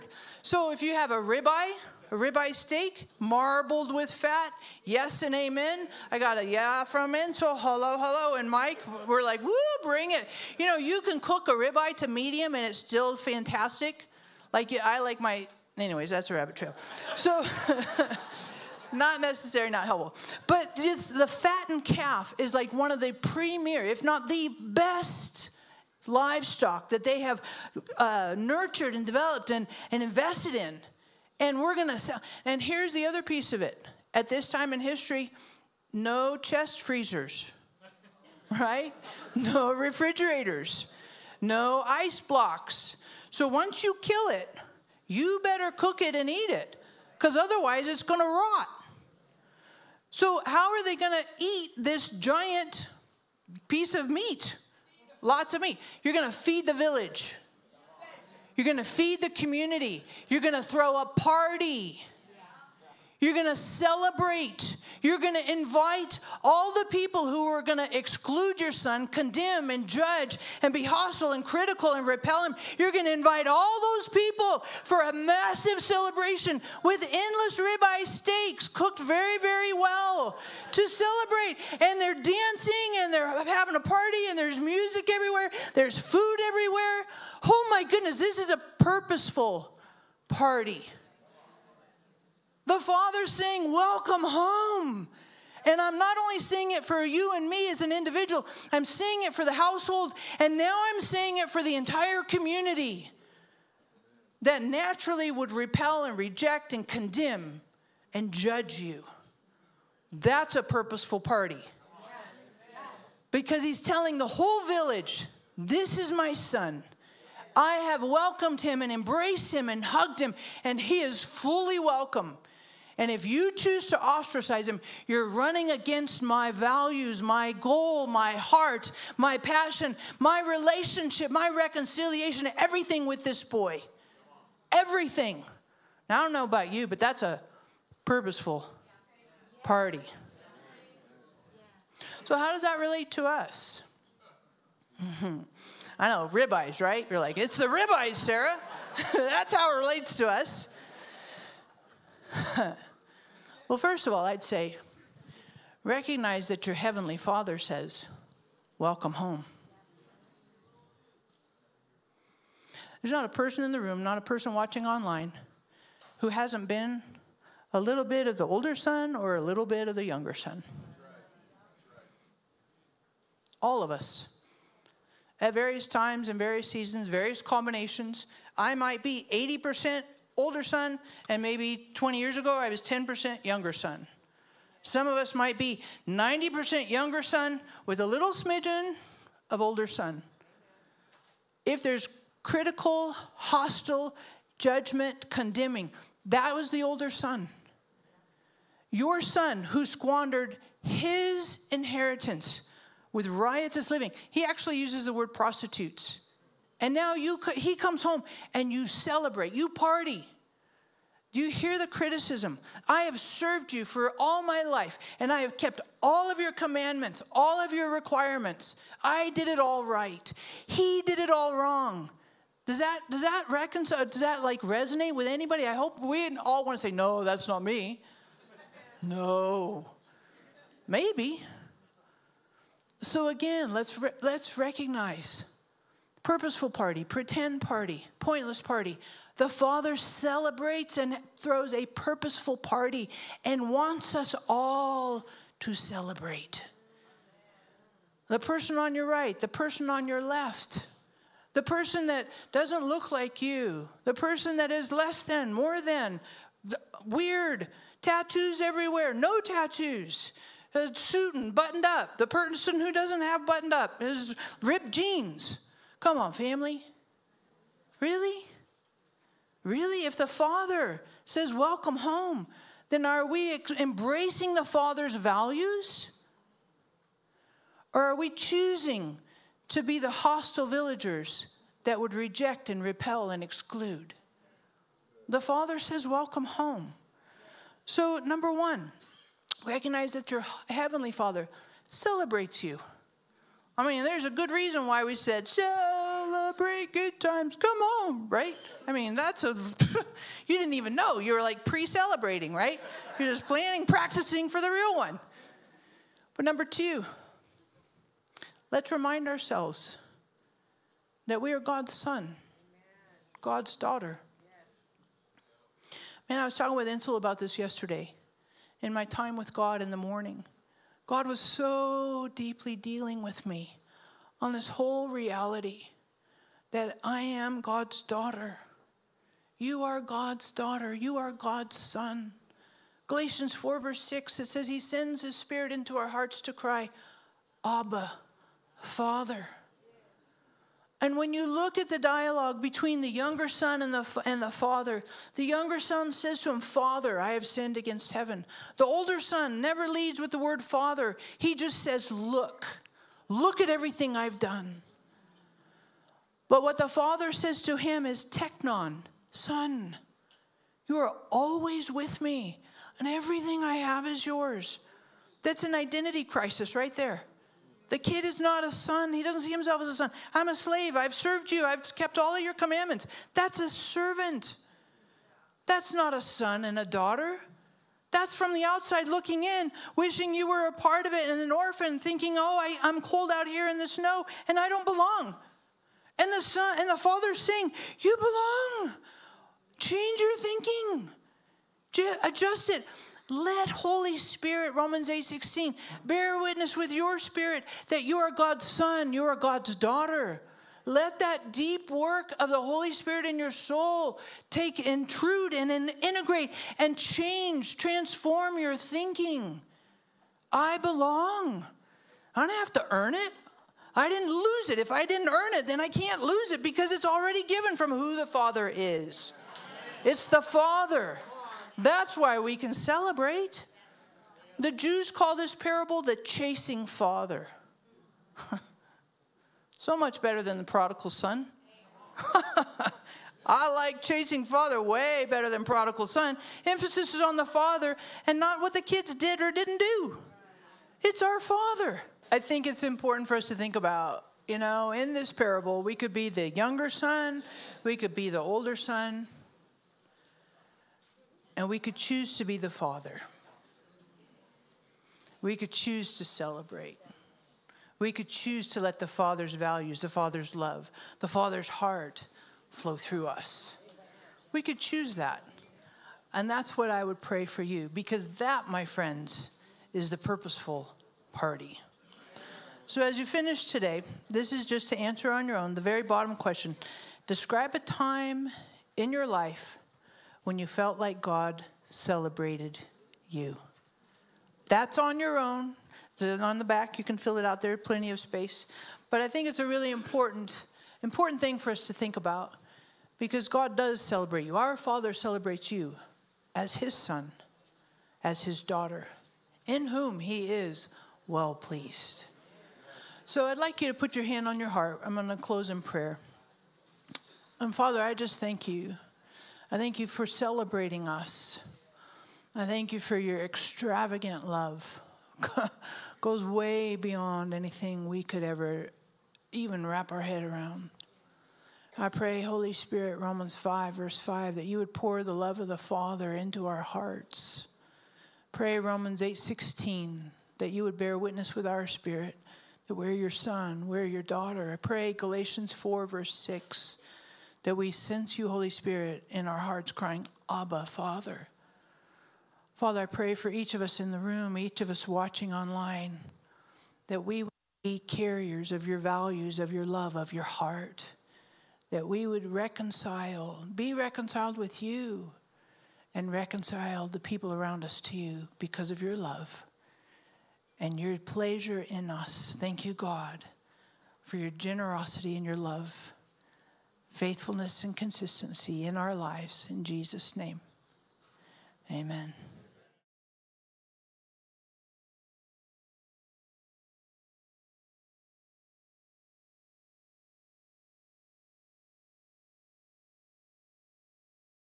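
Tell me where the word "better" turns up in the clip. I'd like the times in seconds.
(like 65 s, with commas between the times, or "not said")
45 s, 430 s, 435 s.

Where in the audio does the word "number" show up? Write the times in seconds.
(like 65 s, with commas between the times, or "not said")
288 s, 306 s.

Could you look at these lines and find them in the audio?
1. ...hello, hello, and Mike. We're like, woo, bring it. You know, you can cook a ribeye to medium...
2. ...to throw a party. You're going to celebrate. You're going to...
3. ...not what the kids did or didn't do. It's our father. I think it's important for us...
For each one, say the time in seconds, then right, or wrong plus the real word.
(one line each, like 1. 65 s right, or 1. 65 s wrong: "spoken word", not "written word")
1. 7 s right
2. 60 s right
3. 438 s right.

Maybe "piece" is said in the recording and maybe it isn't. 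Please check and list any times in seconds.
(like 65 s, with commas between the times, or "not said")
33 s, 53 s.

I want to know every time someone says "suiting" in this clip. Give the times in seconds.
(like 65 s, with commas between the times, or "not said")
260 s.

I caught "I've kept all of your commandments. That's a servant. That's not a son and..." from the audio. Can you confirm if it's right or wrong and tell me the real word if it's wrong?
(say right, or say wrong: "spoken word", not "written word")
right.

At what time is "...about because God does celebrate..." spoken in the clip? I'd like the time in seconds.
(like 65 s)
492 s.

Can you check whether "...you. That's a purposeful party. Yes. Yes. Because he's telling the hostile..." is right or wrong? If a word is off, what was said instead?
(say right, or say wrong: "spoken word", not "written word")
wrong: "whole", not "hostile".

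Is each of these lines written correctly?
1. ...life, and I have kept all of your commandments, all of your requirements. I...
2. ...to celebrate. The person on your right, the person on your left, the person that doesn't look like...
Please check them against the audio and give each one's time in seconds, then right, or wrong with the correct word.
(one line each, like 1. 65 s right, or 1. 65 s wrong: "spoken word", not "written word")
1. 214 s right
2. 245 s right.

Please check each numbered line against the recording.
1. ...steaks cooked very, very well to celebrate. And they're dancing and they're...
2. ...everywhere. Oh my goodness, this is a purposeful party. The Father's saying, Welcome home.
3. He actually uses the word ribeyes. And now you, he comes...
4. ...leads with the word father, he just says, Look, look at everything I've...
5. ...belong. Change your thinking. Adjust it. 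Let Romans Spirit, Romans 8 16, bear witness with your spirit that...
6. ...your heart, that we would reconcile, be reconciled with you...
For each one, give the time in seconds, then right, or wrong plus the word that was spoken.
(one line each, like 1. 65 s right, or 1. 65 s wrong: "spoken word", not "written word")
1. 78 s right
2. 86 s right
3. 204 s wrong: "prostitutes", not "ribeyes"
4. 349 s right
5. 388 s wrong: "Holy", not "Romans"
6. 550 s right.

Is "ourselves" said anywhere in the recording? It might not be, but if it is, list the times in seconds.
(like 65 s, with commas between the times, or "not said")
309 s.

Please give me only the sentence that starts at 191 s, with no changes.
If there's critical, hostile, judgment, condemning, that was the older son.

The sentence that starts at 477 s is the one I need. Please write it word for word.
Describe a time in your life when you felt like God celebrated you.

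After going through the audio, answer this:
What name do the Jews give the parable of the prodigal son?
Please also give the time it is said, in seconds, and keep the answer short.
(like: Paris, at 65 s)
The chasing father, at 426 s.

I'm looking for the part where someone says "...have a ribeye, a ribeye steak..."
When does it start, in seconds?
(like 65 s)
0 s.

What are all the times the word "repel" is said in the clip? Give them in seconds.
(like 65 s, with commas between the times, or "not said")
72 s, 105 s, 282 s.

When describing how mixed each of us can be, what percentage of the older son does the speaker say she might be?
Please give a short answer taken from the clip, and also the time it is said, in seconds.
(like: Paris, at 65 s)
80%, at 179 s.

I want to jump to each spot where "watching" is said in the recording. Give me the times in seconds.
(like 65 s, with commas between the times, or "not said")
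164 s, 545 s.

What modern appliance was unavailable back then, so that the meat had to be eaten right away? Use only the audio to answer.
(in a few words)
Chest freezers.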